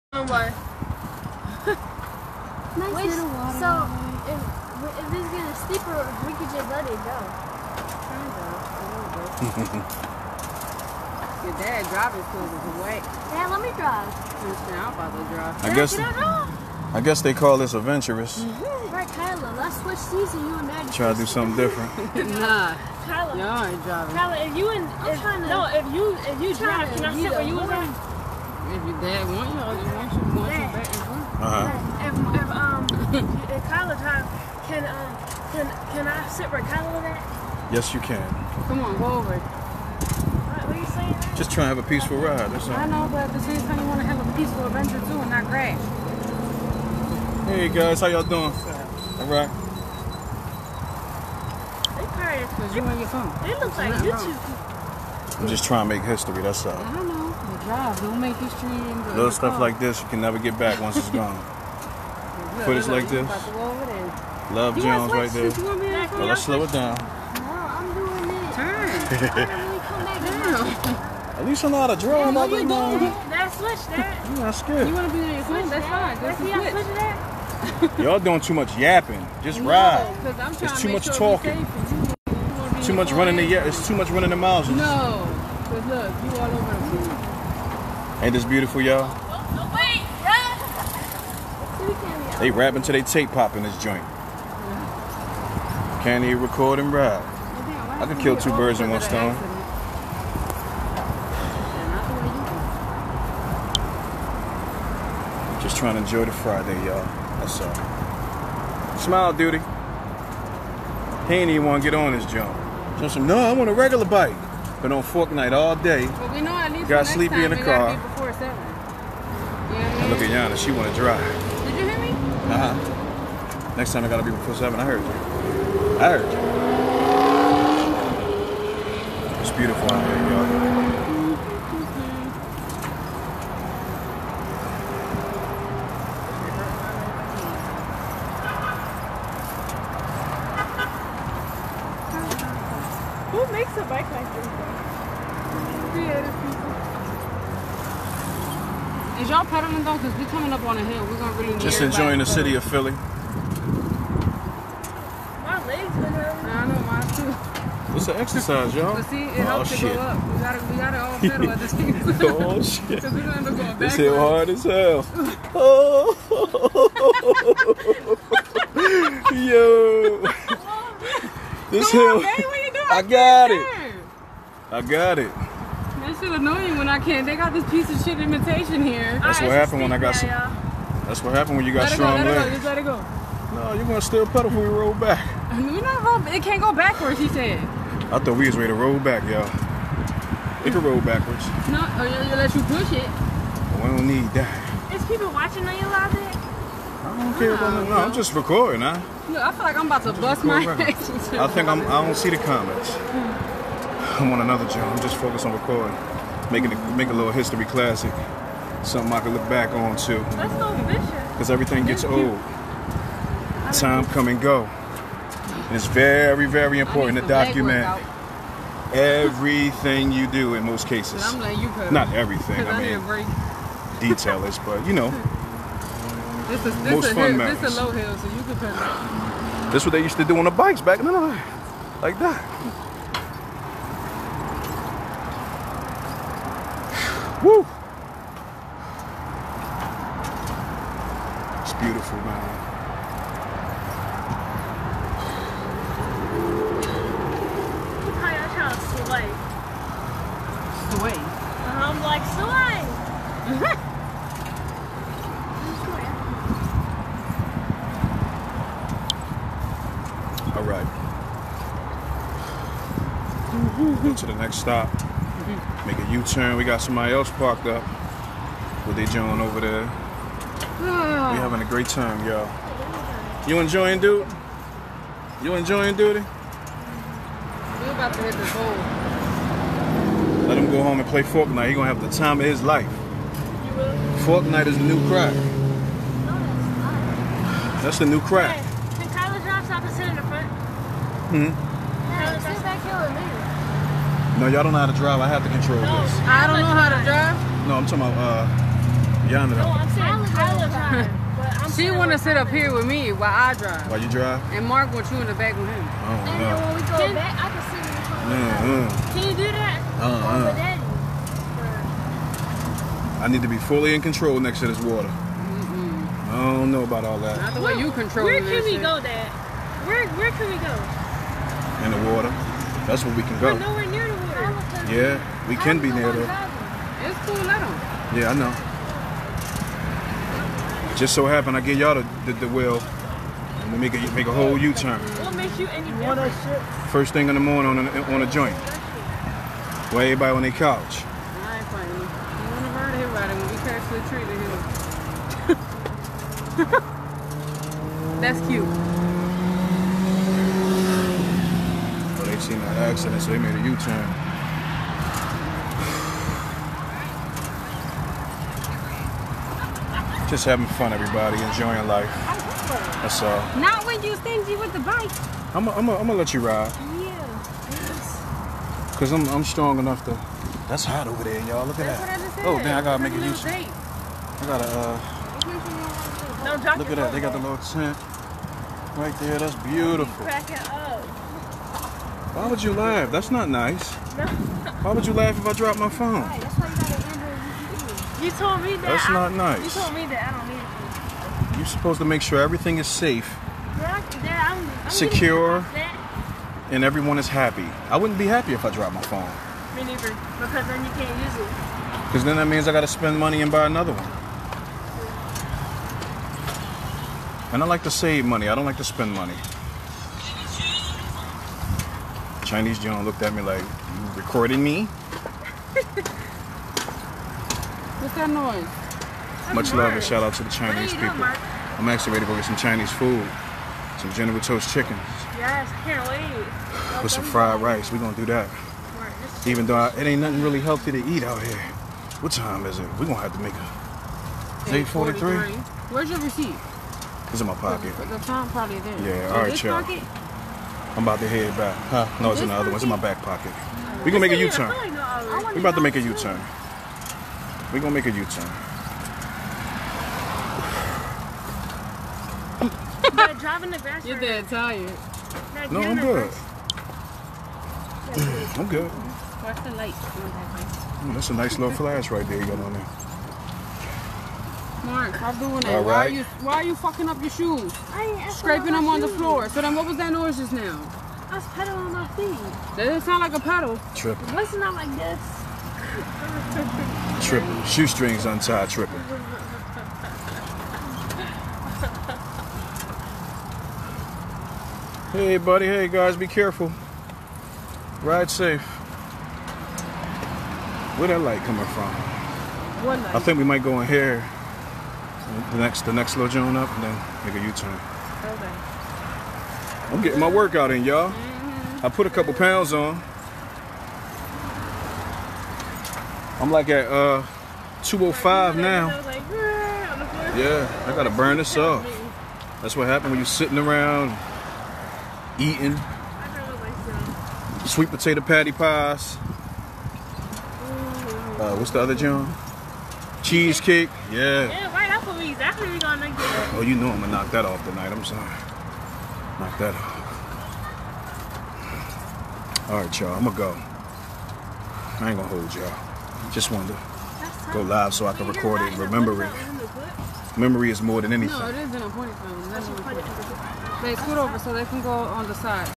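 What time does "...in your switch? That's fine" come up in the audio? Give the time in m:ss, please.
1:15.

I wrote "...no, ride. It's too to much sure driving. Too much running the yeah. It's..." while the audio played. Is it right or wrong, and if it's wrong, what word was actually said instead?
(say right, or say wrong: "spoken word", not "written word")
wrong: "talking", not "driving".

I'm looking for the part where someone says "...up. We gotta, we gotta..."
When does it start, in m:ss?
2:39.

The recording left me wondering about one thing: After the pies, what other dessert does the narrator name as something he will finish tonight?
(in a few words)
Cheesecake.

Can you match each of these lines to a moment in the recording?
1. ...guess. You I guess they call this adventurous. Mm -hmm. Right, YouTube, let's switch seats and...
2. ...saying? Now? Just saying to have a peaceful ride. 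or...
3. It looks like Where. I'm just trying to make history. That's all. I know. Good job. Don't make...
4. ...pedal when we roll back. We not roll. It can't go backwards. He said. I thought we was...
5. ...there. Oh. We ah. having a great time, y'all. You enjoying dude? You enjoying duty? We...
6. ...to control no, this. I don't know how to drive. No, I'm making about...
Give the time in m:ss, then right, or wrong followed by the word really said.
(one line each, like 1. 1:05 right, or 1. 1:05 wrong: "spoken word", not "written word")
1. 0:15 wrong: "Kyla", not "YouTube"
2. 0:40 wrong: "trying", not "saying"
3. 0:53 wrong: "YouTube", not "Where"
4. 3:04 right
5. 4:29 right
6. 4:55 wrong: "talking", not "making".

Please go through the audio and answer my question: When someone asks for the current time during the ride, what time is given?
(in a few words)
8:43.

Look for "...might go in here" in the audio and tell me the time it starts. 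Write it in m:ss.
8:13.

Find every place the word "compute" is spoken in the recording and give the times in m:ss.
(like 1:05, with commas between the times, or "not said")
not said.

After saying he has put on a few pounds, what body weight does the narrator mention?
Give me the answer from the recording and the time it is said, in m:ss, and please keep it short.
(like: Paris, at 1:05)
205, at 8:27.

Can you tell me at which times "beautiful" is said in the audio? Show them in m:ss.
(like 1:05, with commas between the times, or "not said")
1:28, 2:09, 4:01, 6:19.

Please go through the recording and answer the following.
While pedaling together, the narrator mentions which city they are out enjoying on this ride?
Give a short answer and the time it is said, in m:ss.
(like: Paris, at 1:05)
Philly, at 2:32.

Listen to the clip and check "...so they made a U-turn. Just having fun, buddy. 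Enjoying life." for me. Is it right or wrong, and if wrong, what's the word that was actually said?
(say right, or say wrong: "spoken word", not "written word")
wrong: "everybody", not "buddy".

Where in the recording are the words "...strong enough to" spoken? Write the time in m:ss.
6:09.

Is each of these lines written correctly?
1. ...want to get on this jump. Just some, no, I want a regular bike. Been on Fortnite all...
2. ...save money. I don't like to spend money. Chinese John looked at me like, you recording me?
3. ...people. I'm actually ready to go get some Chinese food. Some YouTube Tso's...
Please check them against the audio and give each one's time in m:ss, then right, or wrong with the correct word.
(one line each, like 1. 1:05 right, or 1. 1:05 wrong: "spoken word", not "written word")
1. 1:51 right
2. 6:47 right
3. 7:00 wrong: "General", not "YouTube".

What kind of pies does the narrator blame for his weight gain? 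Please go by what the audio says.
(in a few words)
Sweet potato.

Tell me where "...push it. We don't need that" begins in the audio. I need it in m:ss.
3:12.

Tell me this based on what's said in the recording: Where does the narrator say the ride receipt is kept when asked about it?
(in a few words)
Back pocket.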